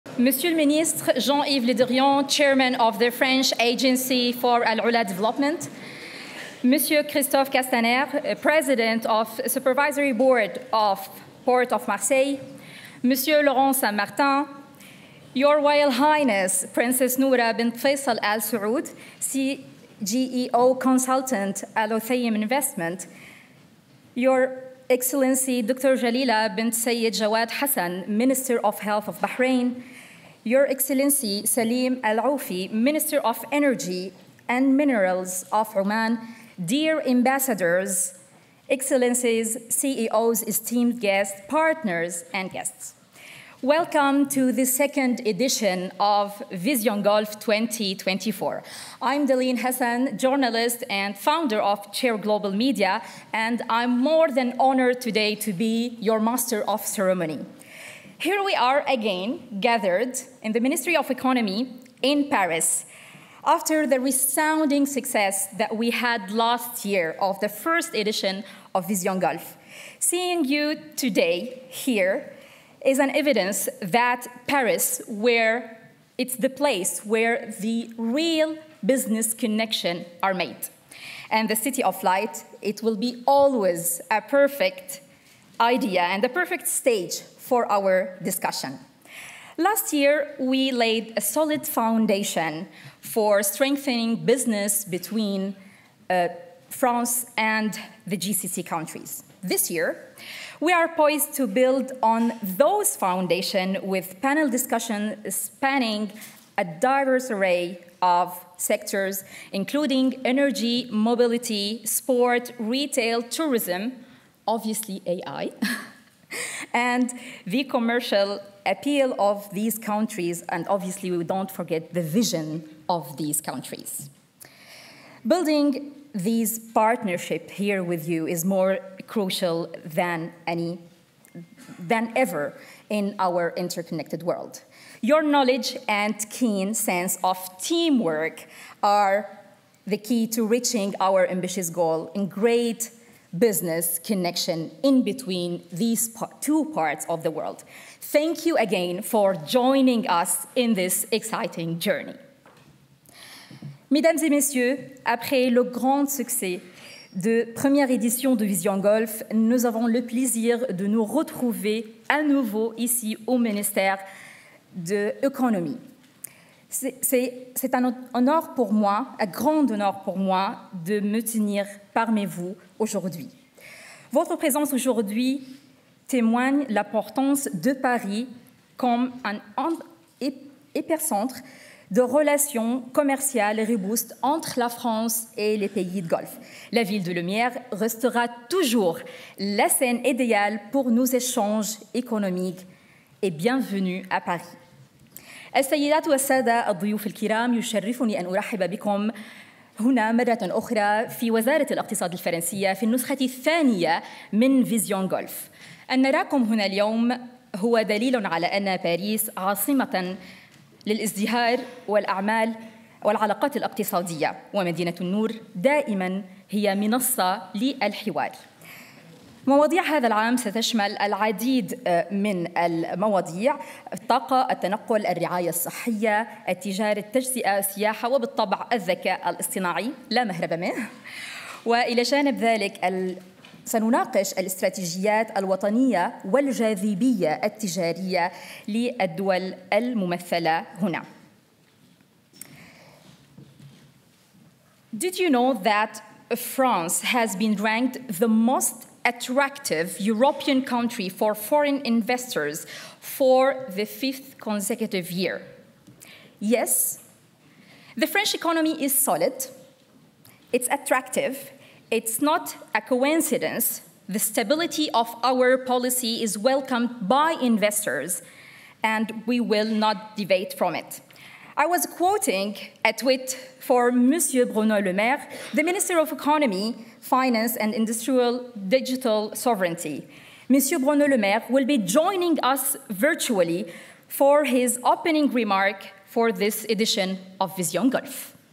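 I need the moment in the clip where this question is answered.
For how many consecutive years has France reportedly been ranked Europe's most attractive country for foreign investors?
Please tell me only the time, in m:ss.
4:13.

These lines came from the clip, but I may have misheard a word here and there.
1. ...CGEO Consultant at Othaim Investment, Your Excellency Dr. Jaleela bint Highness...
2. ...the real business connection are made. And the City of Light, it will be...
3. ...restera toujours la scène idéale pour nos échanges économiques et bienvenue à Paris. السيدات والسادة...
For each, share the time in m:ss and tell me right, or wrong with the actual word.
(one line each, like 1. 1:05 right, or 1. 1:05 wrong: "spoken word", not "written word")
1. 0:19 wrong: "Sayed", not "Highness"
2. 1:17 right
3. 3:07 right.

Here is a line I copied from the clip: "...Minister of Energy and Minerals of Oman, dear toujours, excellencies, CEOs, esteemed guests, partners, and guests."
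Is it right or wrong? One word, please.
wrong.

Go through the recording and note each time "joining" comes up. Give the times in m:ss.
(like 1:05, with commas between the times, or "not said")
2:29, 4:41.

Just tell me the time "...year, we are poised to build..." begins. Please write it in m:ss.
1:39.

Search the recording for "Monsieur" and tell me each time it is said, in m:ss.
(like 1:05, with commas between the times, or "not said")
0:00, 0:06, 0:13, 4:33, 4:40.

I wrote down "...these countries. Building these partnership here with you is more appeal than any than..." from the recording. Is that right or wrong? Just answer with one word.
wrong.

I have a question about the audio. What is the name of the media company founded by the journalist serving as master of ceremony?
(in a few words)
Chair Global Media.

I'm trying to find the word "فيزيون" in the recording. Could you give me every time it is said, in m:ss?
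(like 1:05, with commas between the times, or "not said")
3:24.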